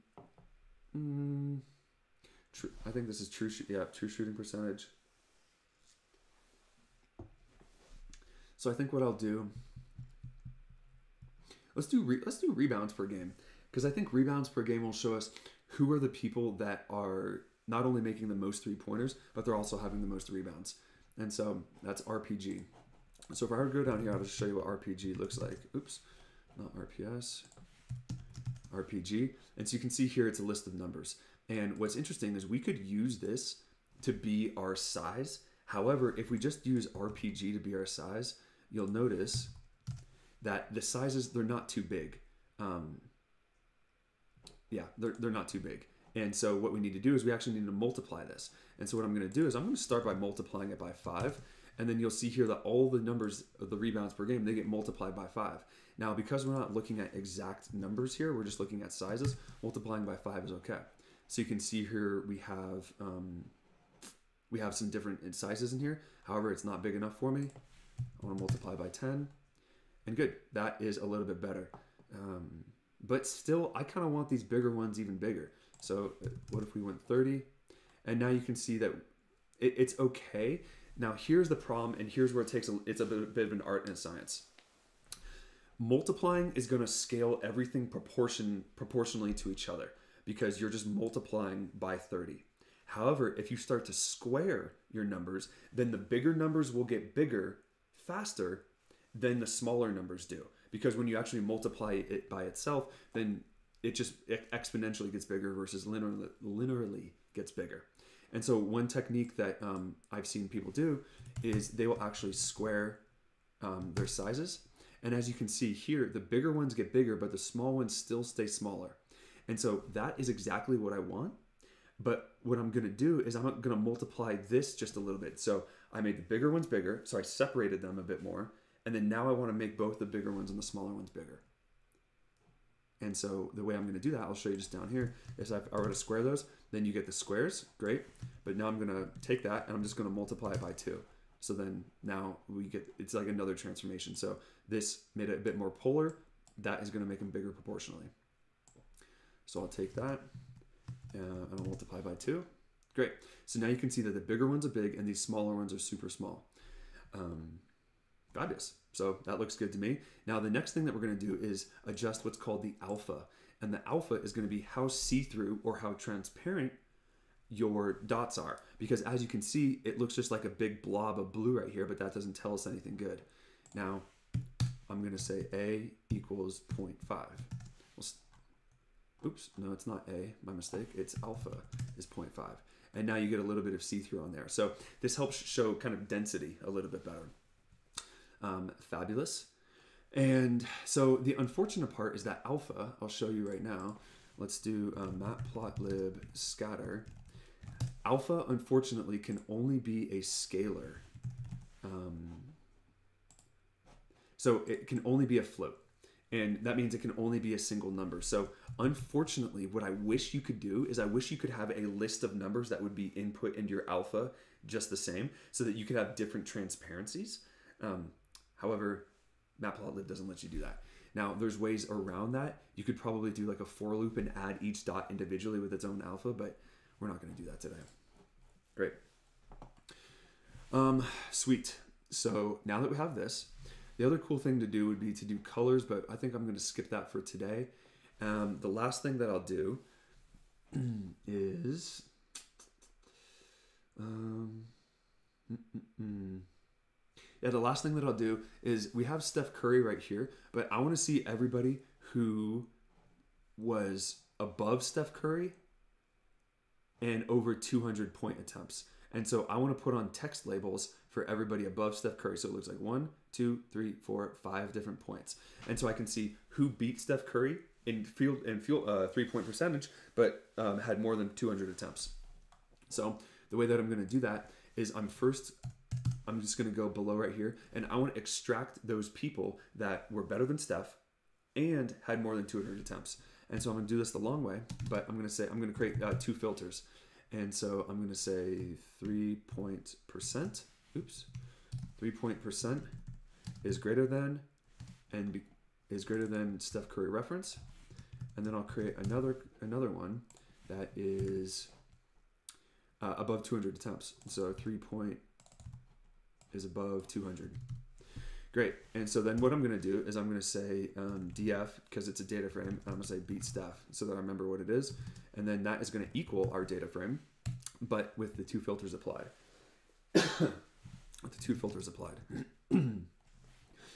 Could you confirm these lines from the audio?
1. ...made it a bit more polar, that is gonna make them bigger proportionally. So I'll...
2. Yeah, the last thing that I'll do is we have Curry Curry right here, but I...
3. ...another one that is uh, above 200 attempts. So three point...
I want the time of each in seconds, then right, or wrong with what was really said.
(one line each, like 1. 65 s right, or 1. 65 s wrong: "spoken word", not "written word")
1. 145 s right
2. 247 s wrong: "Steph", not "Curry"
3. 299 s right.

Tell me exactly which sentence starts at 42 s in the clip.
Um, yeah, they're, they're not too big.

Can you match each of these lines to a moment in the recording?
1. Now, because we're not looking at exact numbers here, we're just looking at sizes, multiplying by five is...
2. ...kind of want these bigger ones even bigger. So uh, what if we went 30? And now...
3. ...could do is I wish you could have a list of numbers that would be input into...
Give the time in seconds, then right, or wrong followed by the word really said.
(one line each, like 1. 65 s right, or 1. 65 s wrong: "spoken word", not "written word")
1. 55 s right
2. 73 s right
3. 210 s right.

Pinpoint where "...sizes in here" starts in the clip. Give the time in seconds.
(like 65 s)
65 s.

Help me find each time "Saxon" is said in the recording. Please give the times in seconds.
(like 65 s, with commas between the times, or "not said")
not said.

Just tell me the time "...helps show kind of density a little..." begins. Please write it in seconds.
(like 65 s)
185 s.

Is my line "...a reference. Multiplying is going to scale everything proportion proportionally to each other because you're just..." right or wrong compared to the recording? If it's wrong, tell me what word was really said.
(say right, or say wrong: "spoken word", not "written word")
wrong: "science", not "reference".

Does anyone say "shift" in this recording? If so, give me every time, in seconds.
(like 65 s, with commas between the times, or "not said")
not said.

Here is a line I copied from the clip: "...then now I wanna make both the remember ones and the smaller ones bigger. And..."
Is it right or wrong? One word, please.
wrong.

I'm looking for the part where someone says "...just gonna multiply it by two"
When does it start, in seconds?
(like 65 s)
139 s.